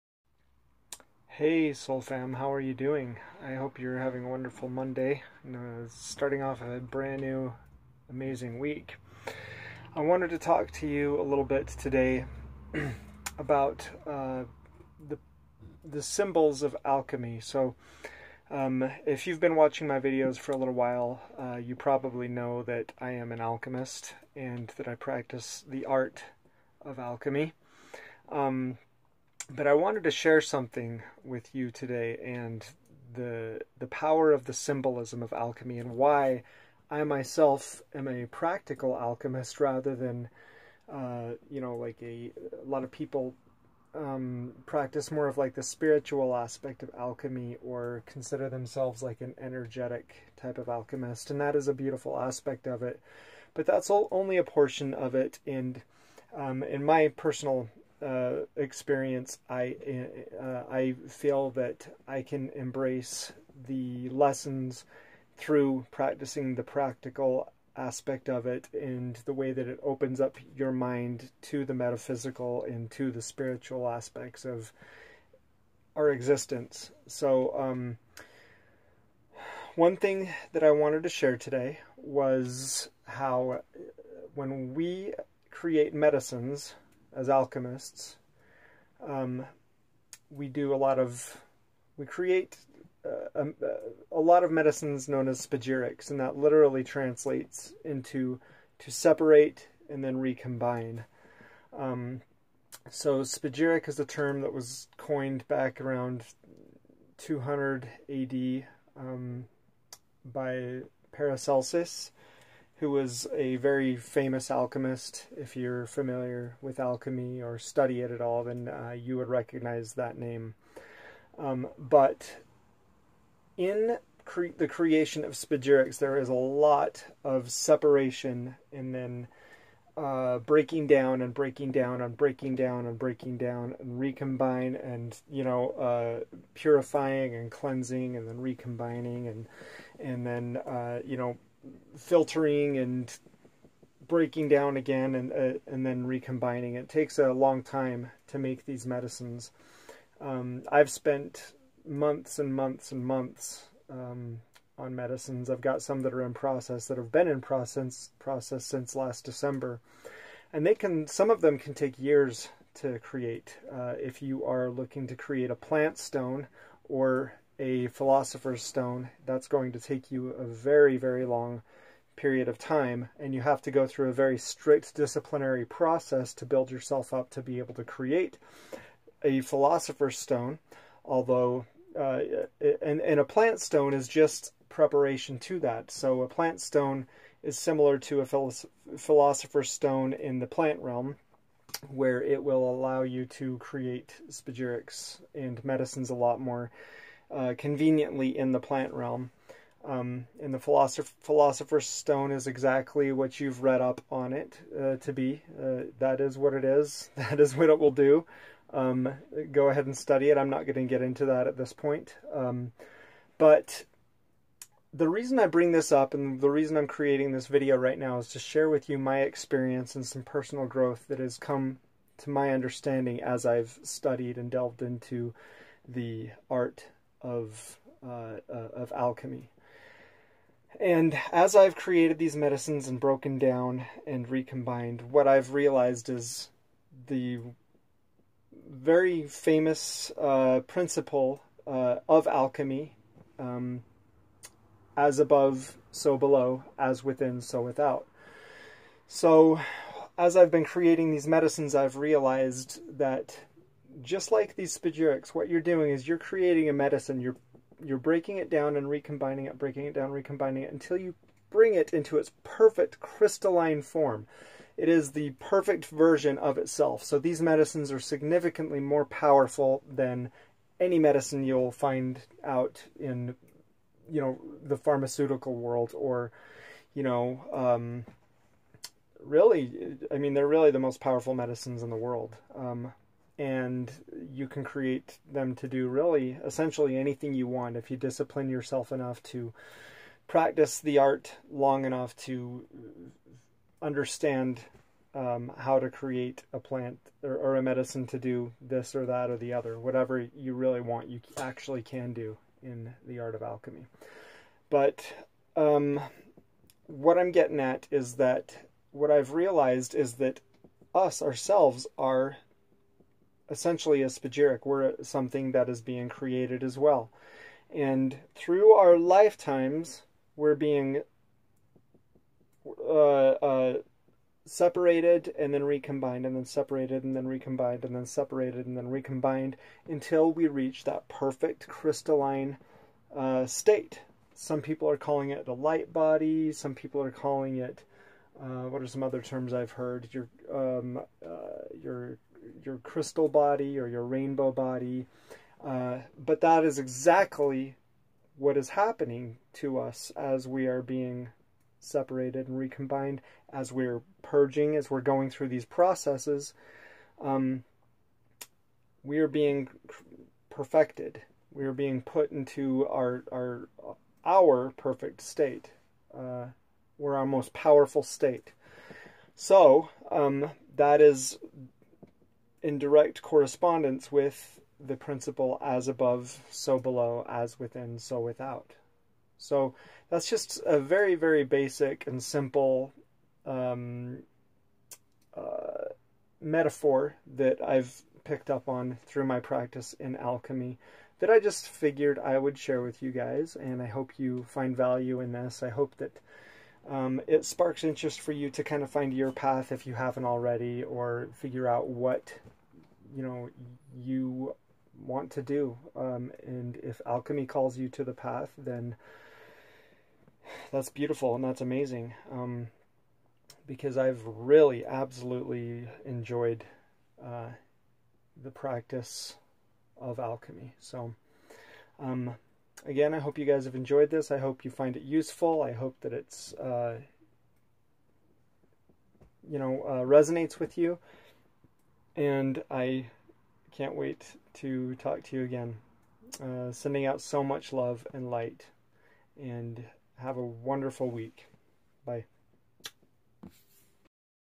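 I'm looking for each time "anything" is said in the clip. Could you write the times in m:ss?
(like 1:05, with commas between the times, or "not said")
4:46.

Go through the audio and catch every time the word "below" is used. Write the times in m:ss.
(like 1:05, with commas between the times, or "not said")
4:06, 6:16.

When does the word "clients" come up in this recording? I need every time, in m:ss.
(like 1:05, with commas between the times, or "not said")
not said.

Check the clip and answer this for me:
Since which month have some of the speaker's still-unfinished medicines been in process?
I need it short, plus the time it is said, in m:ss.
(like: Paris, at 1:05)
December, at 2:38.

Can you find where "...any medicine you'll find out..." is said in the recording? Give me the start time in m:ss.
4:30.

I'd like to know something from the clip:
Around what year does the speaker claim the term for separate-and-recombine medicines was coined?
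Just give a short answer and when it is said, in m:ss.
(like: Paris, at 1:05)
200 AD, at 1:47.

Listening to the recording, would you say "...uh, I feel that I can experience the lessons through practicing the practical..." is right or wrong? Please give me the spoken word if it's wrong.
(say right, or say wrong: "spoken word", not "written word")
wrong: "embrace", not "experience".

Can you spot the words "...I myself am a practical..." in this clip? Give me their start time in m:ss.
0:36.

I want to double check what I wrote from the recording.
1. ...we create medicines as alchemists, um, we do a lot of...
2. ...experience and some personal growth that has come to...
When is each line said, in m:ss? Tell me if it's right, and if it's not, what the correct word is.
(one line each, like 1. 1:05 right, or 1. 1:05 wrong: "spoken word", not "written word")
1. 1:24 right
2. 3:39 right.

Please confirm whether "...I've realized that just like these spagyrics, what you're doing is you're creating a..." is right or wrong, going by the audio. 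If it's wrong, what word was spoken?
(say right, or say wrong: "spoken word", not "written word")
right.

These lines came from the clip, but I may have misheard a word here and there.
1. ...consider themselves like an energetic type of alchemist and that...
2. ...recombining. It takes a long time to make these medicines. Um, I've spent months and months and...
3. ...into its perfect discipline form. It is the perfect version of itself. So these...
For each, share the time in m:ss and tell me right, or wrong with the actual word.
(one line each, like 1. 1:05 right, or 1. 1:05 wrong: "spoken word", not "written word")
1. 0:48 right
2. 2:26 right
3. 4:21 wrong: "crystalline", not "discipline".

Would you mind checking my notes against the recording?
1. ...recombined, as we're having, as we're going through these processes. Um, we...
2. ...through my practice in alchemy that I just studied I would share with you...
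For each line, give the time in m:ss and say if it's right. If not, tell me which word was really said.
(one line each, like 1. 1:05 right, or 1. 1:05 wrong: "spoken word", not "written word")
1. 5:52 wrong: "purging", not "having"
2. 6:29 wrong: "figured", not "studied".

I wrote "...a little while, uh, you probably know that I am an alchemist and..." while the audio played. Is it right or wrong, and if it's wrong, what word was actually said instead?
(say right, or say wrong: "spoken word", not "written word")
right.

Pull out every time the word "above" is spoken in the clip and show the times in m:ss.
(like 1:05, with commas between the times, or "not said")
4:05, 6:15.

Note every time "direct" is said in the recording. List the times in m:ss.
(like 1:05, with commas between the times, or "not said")
6:12.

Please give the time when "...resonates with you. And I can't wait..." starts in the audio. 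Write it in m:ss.
7:10.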